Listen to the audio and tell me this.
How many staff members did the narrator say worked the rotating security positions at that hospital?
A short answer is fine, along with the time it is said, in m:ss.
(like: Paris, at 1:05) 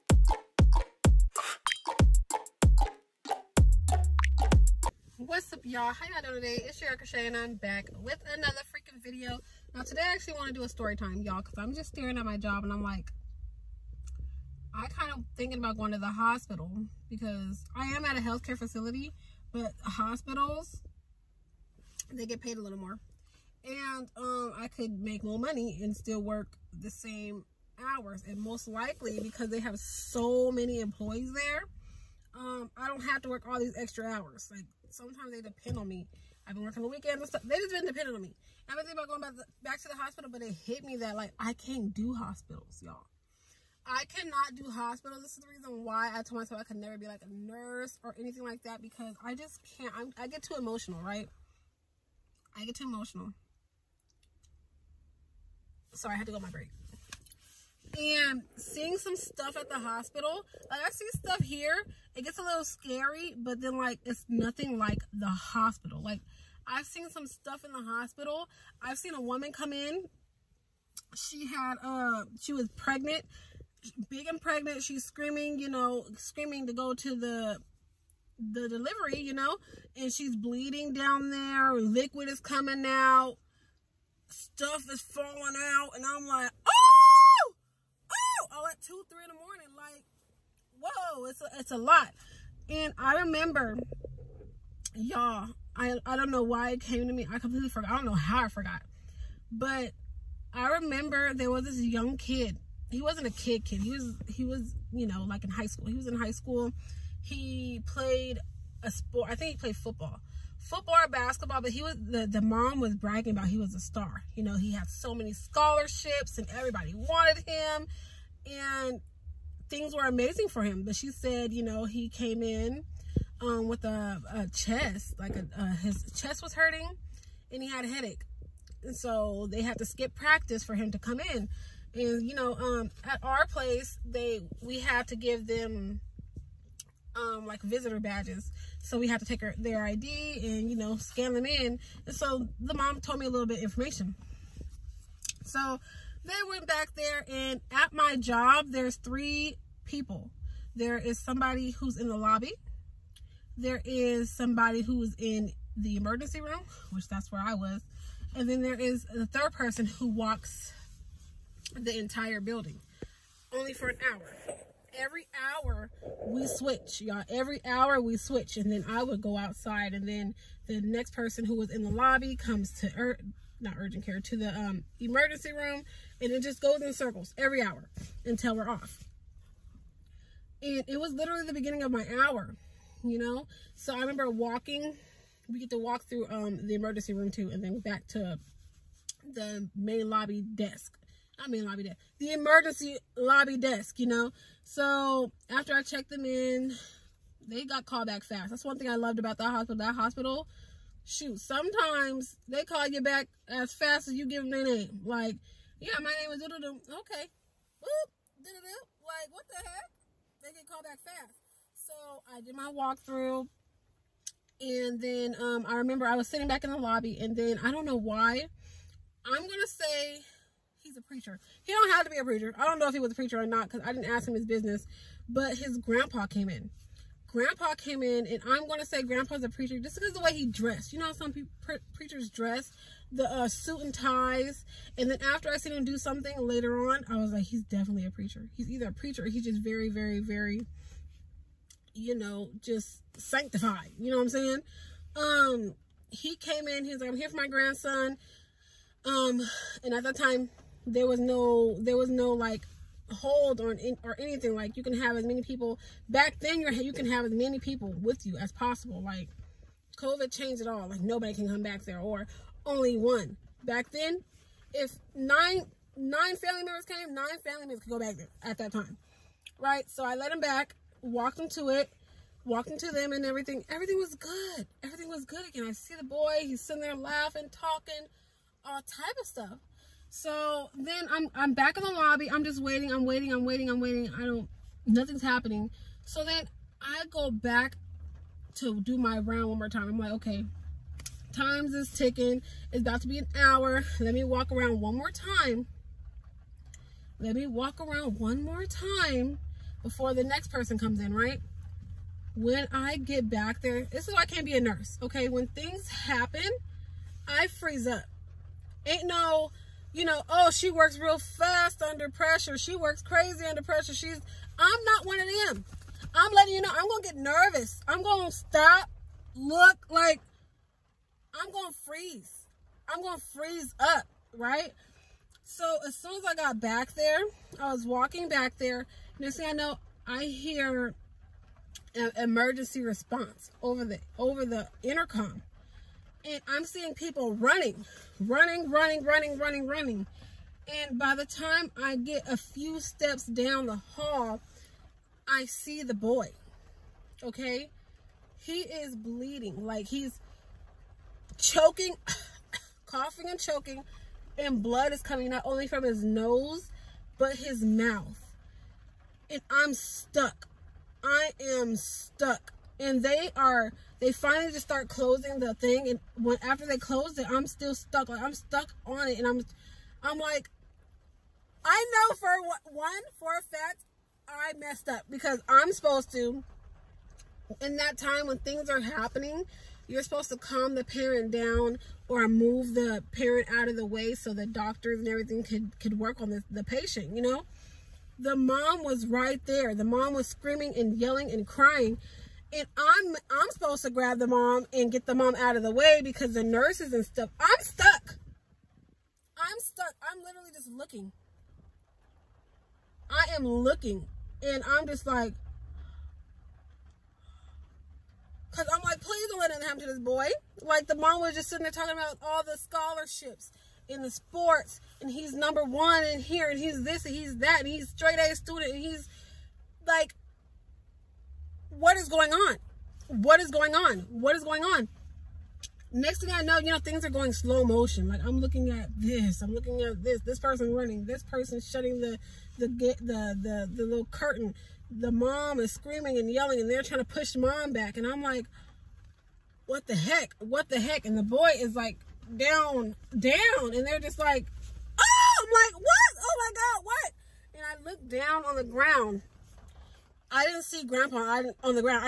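3, at 2:28.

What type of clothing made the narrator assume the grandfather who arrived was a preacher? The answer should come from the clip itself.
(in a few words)
Suit and ties.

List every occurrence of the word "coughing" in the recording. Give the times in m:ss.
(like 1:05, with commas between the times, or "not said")
5:52.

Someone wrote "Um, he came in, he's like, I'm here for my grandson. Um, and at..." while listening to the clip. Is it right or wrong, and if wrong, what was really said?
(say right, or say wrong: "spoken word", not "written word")
right.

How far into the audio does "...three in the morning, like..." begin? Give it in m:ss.
1:29.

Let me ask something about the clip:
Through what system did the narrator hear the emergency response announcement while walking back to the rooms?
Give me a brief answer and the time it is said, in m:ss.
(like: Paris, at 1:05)
The intercom, at 5:34.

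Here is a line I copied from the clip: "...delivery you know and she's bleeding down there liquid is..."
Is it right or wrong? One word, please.
right.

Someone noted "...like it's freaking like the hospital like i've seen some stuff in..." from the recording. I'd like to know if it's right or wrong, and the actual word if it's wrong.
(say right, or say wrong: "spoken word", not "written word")
wrong: "nothing", not "freaking".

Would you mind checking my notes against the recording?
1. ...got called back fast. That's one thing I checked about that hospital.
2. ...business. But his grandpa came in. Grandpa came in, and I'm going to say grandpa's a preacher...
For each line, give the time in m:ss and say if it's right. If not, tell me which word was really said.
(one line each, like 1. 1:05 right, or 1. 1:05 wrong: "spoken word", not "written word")
1. 3:17 wrong: "loved", not "checked"
2. 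3:44 right.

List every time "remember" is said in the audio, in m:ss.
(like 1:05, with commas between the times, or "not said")
1:33, 1:40, 3:03, 3:35.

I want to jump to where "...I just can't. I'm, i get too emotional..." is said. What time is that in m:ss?
0:49.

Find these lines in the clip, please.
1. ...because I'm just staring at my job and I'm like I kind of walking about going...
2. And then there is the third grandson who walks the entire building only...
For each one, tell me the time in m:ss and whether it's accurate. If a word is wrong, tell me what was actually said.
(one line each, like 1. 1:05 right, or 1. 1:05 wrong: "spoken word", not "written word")
1. 0:11 wrong: "thinking", not "walking"
2. 2:38 wrong: "person", not "grandson".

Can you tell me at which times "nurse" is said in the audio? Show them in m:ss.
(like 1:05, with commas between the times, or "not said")
0:47, 5:04, 6:36.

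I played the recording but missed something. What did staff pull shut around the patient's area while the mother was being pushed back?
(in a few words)
The little curtain.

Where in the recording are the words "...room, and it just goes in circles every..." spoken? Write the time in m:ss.
2:55.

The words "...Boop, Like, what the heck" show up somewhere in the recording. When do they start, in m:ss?
3:27.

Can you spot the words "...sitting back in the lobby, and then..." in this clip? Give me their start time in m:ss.
3:36.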